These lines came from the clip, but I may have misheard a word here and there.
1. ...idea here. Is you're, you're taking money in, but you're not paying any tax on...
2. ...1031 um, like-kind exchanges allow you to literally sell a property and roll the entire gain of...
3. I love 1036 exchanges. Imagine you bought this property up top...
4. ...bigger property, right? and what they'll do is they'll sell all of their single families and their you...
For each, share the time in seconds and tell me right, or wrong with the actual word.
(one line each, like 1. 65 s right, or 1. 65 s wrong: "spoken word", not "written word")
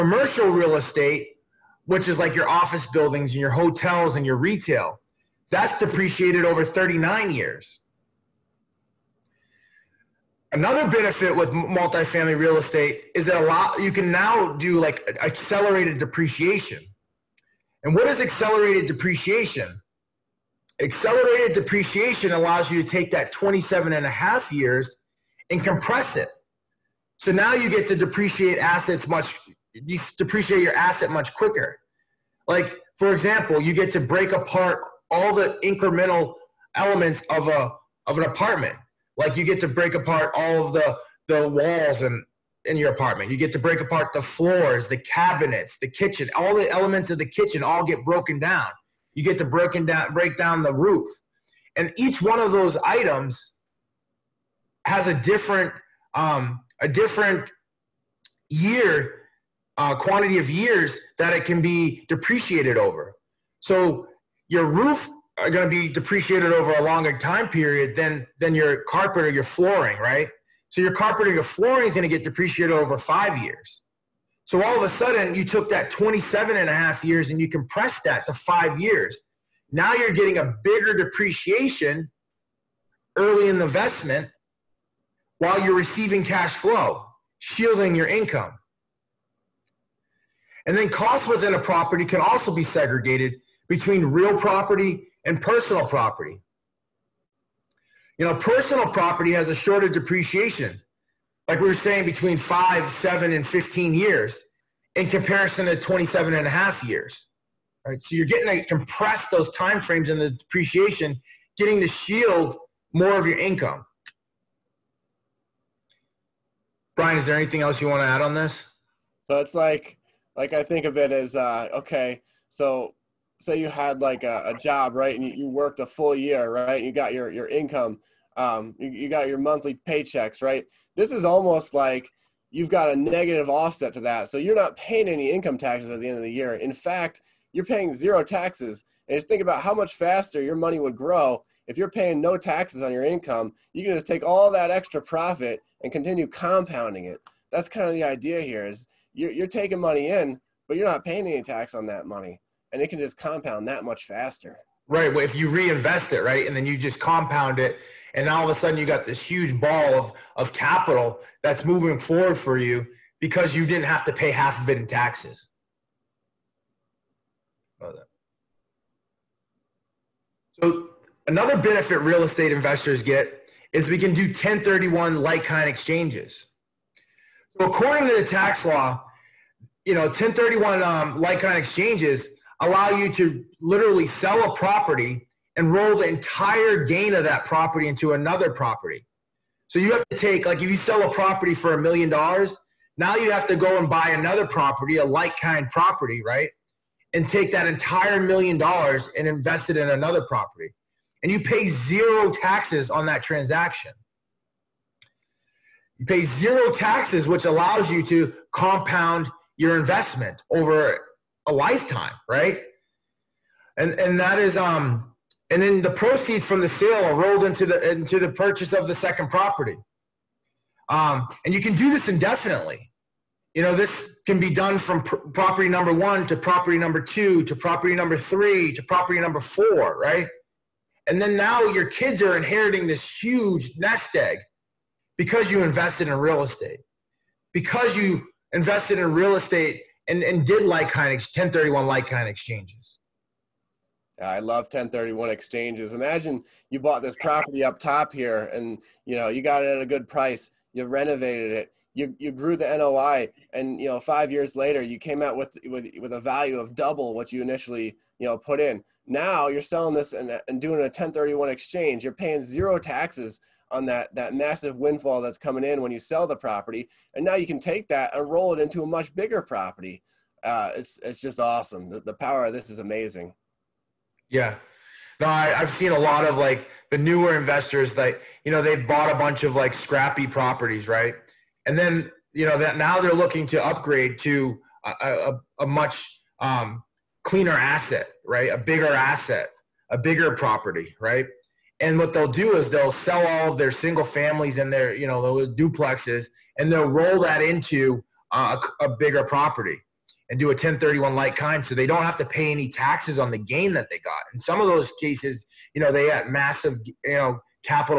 1. 148 s right
2. 180 s right
3. 244 s wrong: "1031", not "1036"
4. 289 s right.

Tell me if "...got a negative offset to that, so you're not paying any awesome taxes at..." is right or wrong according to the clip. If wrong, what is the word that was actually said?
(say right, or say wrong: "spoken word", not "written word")
wrong: "income", not "awesome".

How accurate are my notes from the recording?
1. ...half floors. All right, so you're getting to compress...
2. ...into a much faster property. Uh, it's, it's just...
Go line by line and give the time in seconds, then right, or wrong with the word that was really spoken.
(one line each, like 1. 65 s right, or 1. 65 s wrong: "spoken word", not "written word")
1. 106 s wrong: "years", not "floors"
2. 268 s wrong: "bigger", not "faster".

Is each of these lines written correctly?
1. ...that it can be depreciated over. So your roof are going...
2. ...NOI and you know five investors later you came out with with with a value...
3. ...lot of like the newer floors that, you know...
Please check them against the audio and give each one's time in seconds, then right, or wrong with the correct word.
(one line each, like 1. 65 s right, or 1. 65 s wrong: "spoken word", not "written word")
1. 61 s right
2. 252 s wrong: "years", not "investors"
3. 275 s wrong: "investors", not "floors".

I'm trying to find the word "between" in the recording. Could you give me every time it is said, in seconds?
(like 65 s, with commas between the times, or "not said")
93 s, 102 s.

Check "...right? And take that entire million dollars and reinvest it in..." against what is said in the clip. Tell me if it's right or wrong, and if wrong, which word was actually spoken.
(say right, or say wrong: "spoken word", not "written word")
wrong: "invest", not "reinvest".